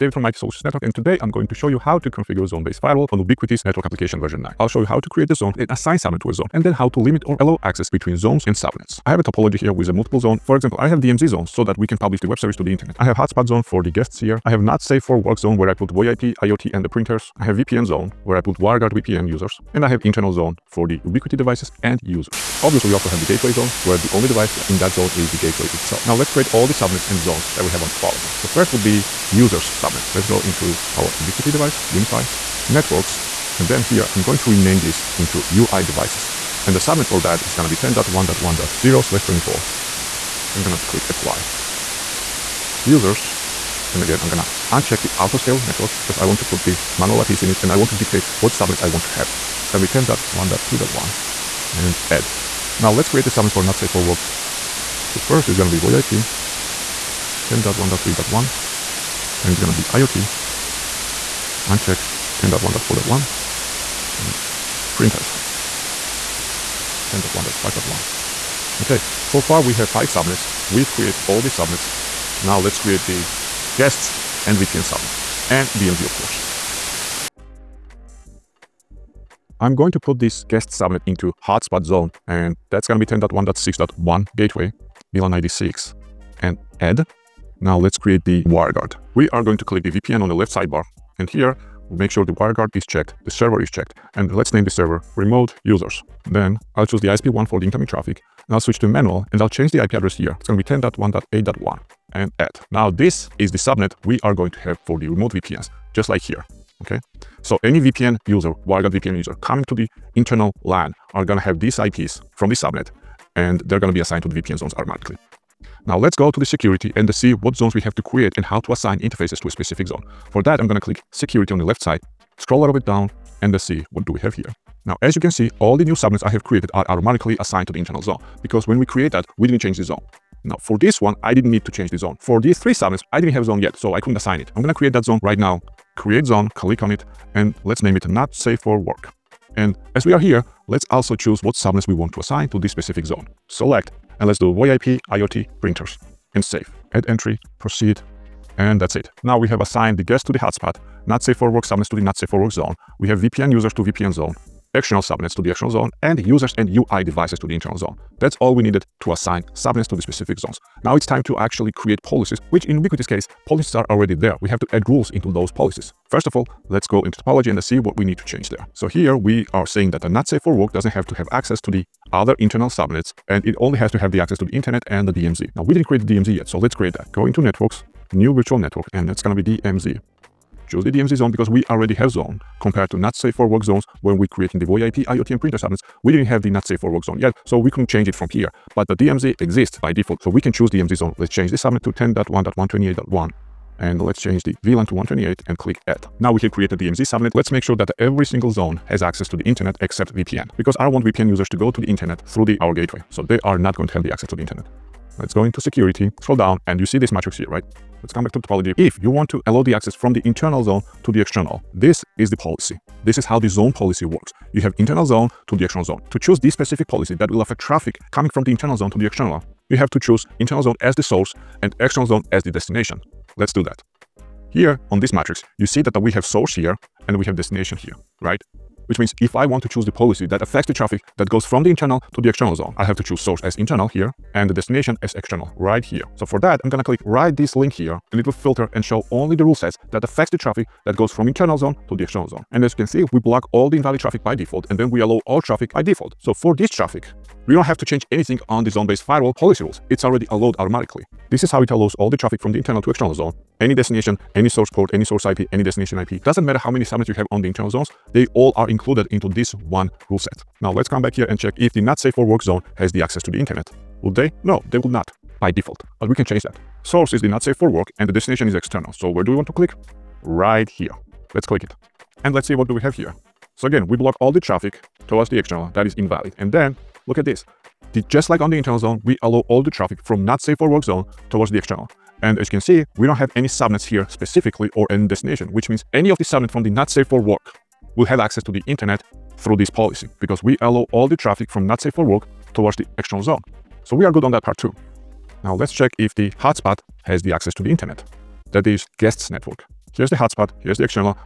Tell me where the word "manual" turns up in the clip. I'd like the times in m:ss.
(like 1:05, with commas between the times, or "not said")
0:46, 1:38.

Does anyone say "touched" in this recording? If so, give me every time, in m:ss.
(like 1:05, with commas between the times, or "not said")
not said.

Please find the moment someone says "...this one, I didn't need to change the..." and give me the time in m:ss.
2:10.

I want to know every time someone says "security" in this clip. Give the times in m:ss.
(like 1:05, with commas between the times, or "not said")
1:56, 2:01, 3:25.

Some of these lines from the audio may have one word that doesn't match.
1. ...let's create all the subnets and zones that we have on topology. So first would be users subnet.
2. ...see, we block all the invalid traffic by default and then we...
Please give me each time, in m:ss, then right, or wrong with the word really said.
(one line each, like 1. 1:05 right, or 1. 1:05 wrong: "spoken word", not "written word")
1. 0:26 right
2. 4:02 right.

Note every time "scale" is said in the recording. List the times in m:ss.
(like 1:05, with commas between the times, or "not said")
0:45.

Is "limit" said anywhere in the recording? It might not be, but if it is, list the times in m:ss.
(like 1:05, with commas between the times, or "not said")
0:06.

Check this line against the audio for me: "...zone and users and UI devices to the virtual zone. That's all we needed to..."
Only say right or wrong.
wrong.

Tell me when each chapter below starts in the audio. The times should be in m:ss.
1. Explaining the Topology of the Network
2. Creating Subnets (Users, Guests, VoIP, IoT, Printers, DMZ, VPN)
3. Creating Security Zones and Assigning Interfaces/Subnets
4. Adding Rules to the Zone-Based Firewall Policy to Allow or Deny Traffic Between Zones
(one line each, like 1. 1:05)
1. 0:07
2. 0:25
3. 1:55
4. 2:40.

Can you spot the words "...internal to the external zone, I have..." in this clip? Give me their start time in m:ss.
3:51.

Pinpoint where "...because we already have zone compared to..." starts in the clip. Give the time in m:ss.
3:01.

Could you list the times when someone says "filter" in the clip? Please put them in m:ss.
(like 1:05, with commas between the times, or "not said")
3:58.